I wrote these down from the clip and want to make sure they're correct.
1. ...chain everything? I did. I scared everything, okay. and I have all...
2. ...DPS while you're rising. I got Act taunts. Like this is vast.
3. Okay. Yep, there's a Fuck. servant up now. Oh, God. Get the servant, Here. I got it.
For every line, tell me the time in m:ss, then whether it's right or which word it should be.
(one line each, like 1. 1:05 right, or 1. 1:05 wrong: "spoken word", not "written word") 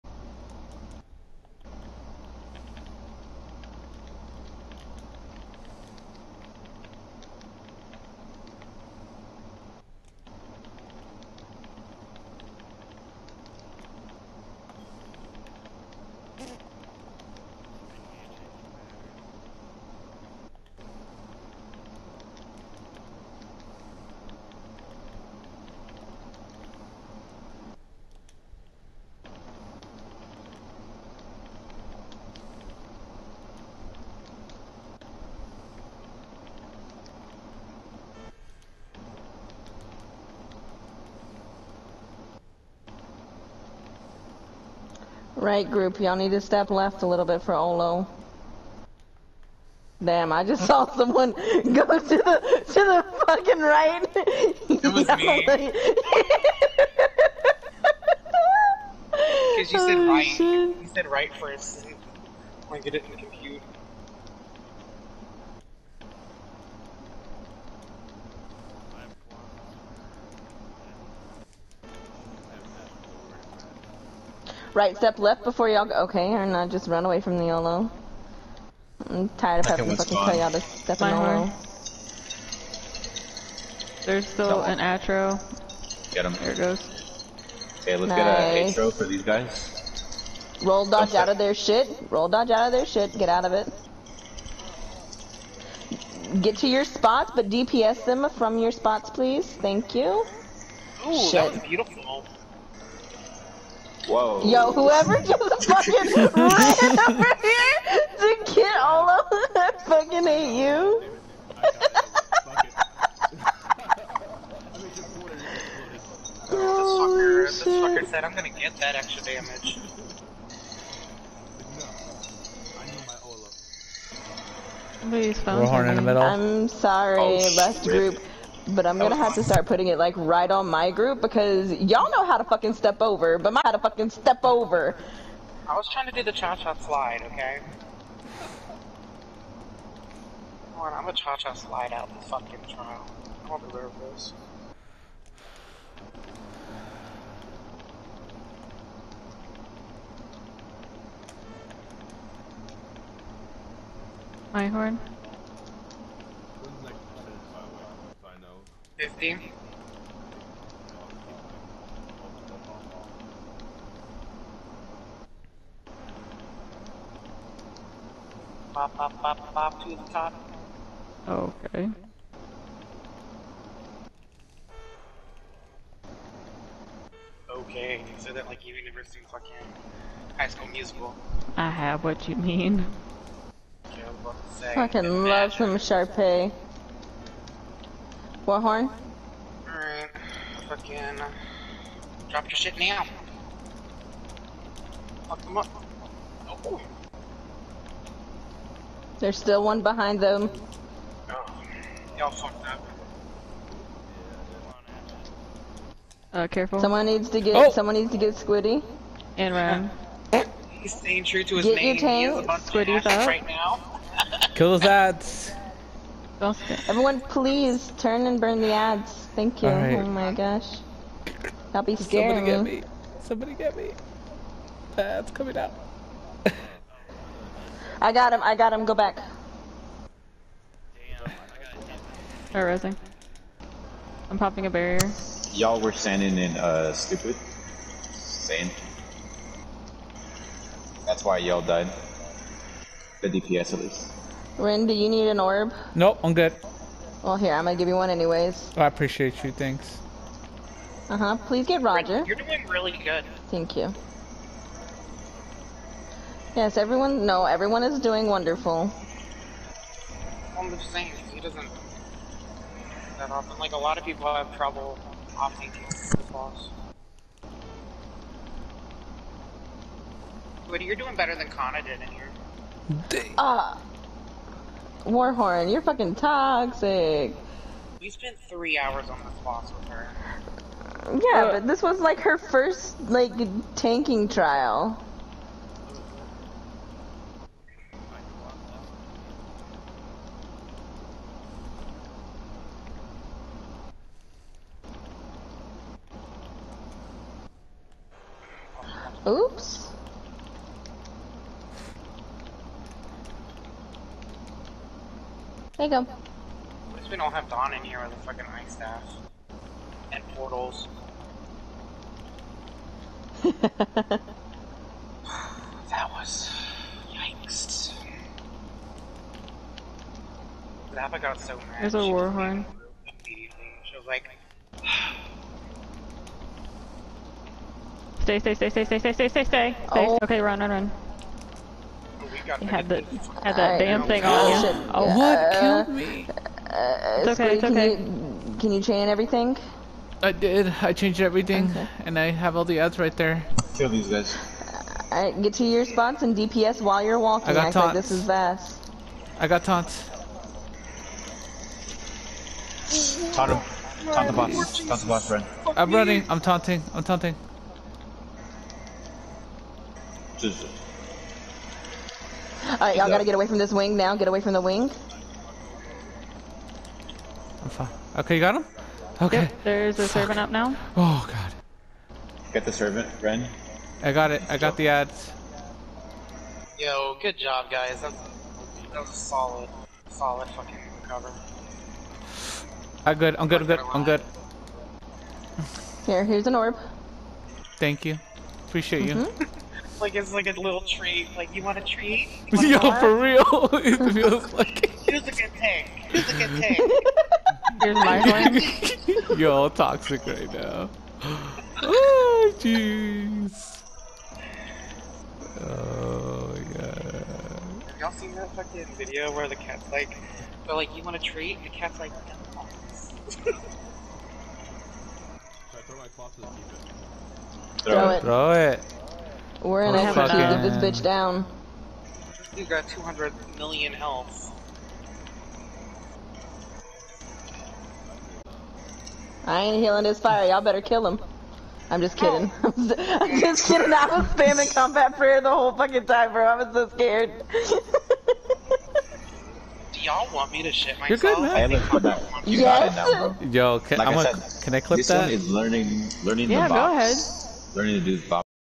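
1. 5:38 wrong: "changed", not "scared"
2. 5:46 wrong: "walking", not "rising"
3. 6:09 wrong: "Ren", not "Here".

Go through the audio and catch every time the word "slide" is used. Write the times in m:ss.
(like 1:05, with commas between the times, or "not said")
2:16, 2:21.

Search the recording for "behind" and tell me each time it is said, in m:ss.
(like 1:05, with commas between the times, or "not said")
3:19.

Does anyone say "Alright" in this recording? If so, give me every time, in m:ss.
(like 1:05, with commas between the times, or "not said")
3:09, 6:02.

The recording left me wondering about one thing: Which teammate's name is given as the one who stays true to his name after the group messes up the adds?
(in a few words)
Ram.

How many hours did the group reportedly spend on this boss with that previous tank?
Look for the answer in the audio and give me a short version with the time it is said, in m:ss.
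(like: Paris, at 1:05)
3, at 4:38.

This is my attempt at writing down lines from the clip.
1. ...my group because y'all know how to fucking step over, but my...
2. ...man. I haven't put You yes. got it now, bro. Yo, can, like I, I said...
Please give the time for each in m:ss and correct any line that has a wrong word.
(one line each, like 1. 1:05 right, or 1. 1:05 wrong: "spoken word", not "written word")
1. 2:10 right
2. 7:21 right.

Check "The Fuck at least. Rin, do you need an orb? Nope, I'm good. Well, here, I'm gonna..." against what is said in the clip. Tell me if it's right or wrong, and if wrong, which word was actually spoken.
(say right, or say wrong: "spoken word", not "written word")
wrong: "DPS", not "Fuck".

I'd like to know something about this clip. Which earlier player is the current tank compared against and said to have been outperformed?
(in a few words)
Kana.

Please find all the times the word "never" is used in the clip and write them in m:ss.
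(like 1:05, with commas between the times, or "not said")
2:58.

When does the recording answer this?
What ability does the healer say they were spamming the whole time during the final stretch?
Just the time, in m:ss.
7:14.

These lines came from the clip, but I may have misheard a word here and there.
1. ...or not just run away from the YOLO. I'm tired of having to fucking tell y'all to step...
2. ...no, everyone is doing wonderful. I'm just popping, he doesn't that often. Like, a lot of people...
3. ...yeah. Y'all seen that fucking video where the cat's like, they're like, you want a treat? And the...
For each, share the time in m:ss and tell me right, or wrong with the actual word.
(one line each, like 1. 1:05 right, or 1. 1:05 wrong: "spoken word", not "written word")
1. 1:16 right
2. 4:17 wrong: "saying", not "popping"
3. 6:46 right.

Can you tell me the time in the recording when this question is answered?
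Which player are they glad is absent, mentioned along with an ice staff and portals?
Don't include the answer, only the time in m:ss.
5:07.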